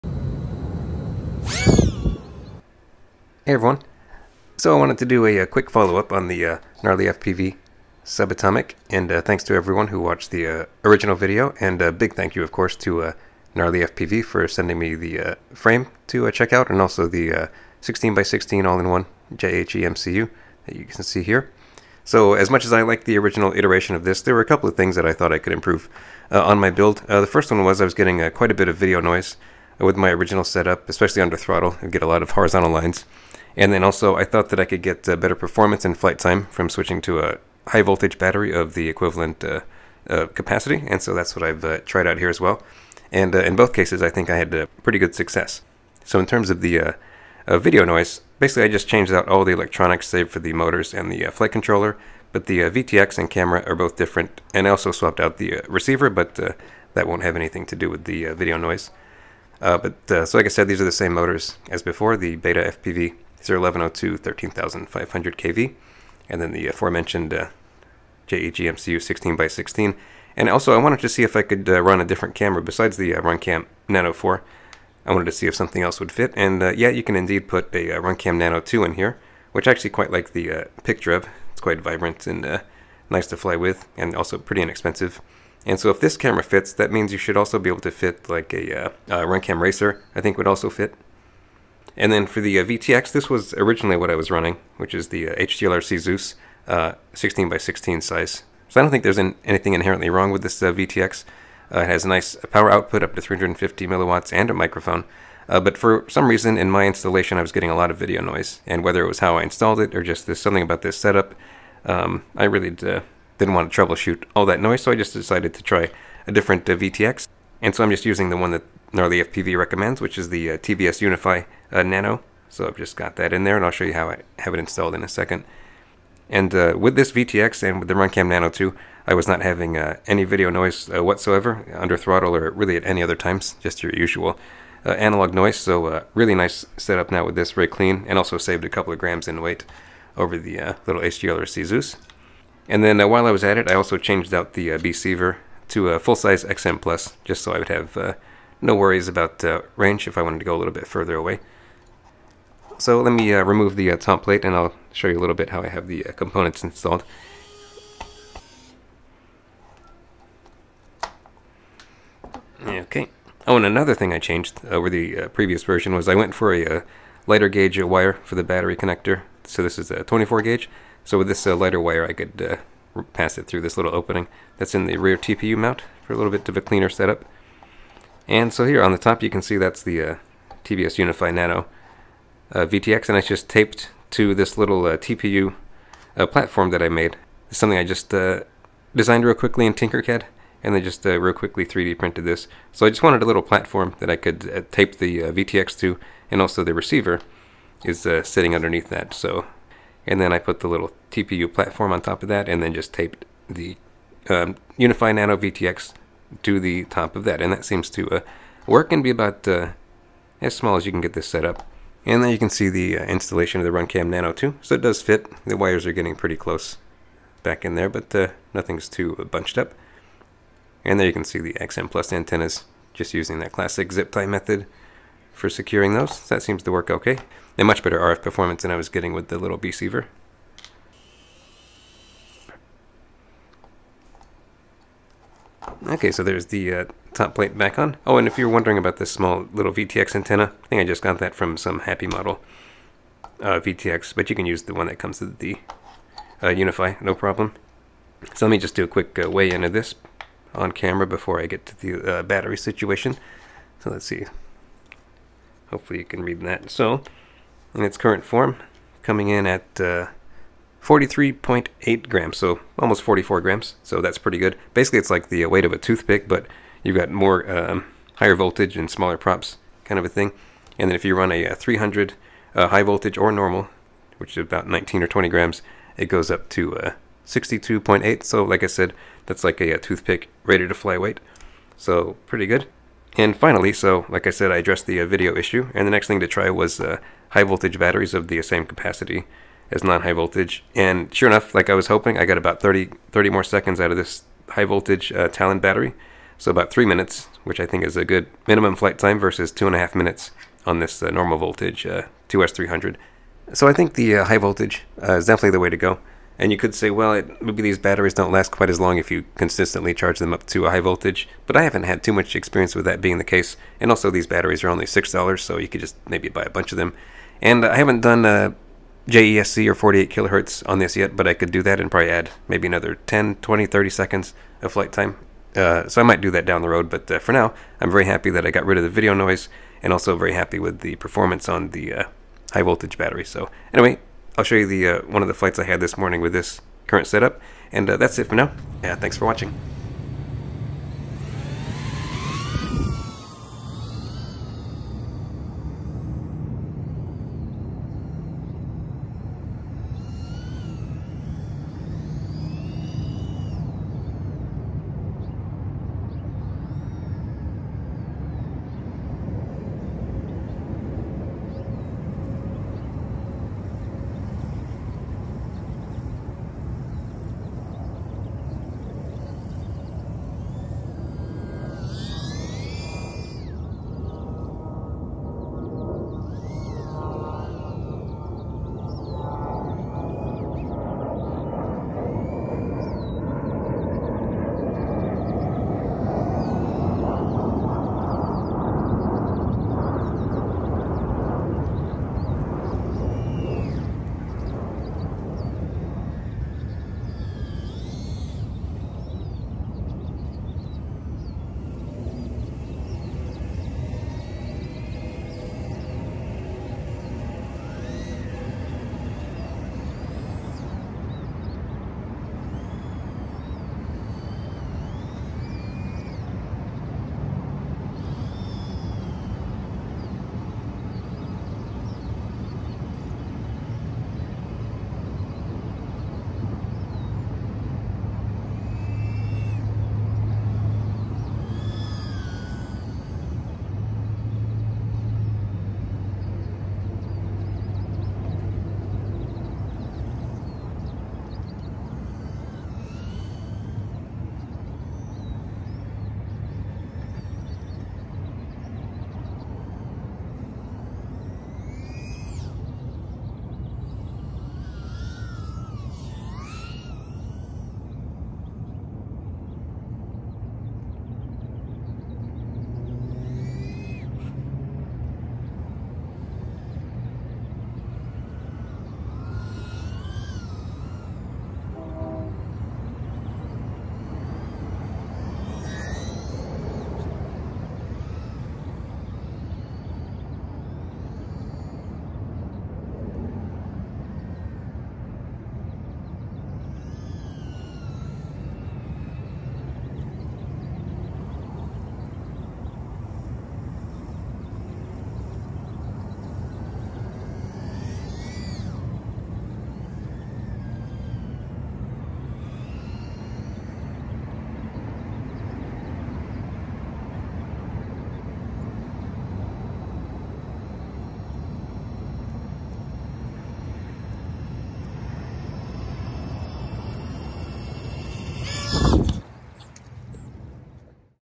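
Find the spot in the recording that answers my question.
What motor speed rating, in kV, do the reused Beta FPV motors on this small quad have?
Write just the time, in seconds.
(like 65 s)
64 s.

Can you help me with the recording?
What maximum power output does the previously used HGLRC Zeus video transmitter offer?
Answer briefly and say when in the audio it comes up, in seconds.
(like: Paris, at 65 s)
350 milliwatts, at 103 s.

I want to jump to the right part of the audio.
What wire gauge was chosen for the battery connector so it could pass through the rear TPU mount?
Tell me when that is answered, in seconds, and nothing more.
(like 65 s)
170 s.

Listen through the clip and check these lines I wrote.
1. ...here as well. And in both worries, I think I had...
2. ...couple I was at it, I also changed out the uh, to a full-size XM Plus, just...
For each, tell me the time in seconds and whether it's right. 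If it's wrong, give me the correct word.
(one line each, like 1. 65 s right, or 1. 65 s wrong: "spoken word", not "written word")
1. 42 s wrong: "cases", not "worries"
2. 143 s wrong: "while", not "couple".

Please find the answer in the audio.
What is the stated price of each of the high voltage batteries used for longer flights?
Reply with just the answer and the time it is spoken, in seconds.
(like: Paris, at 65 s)
$6, at 314 s.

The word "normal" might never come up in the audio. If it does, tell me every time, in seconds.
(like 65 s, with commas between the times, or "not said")
273 s, 301 s.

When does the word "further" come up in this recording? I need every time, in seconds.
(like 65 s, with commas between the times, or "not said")
150 s.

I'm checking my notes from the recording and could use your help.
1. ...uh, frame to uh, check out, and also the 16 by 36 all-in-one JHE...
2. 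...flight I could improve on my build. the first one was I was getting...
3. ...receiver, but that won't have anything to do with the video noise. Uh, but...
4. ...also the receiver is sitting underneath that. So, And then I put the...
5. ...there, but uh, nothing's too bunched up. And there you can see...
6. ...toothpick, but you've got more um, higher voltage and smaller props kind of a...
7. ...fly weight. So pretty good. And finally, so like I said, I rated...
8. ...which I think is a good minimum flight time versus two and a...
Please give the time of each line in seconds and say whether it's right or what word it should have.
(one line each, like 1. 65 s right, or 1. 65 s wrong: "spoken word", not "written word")
1. 15 s wrong: "16", not "36"
2. 25 s wrong: "thought", not "flight"
3. 55 s right
4. 196 s right
5. 217 s right
6. 265 s right
7. 280 s wrong: "addressed", not "rated"
8. 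297 s right.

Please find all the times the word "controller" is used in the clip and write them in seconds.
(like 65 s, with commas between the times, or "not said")
51 s.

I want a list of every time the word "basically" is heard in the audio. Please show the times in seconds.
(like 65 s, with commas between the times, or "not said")
48 s, 264 s.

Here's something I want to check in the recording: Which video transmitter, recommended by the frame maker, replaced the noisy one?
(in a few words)
TBS Unify Nano.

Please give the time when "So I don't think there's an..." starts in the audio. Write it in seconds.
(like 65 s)
98 s.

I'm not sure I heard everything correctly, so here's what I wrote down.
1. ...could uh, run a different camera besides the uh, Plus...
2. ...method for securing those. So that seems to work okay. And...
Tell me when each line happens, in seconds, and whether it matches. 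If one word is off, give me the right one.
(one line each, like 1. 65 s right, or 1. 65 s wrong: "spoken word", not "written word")
1. 71 s wrong: "Runcam", not "Plus"
2. 224 s right.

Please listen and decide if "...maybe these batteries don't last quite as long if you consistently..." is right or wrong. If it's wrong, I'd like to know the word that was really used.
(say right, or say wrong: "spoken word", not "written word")
right.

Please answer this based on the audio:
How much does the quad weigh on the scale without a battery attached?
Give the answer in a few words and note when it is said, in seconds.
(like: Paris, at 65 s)
43.8 grams, at 260 s.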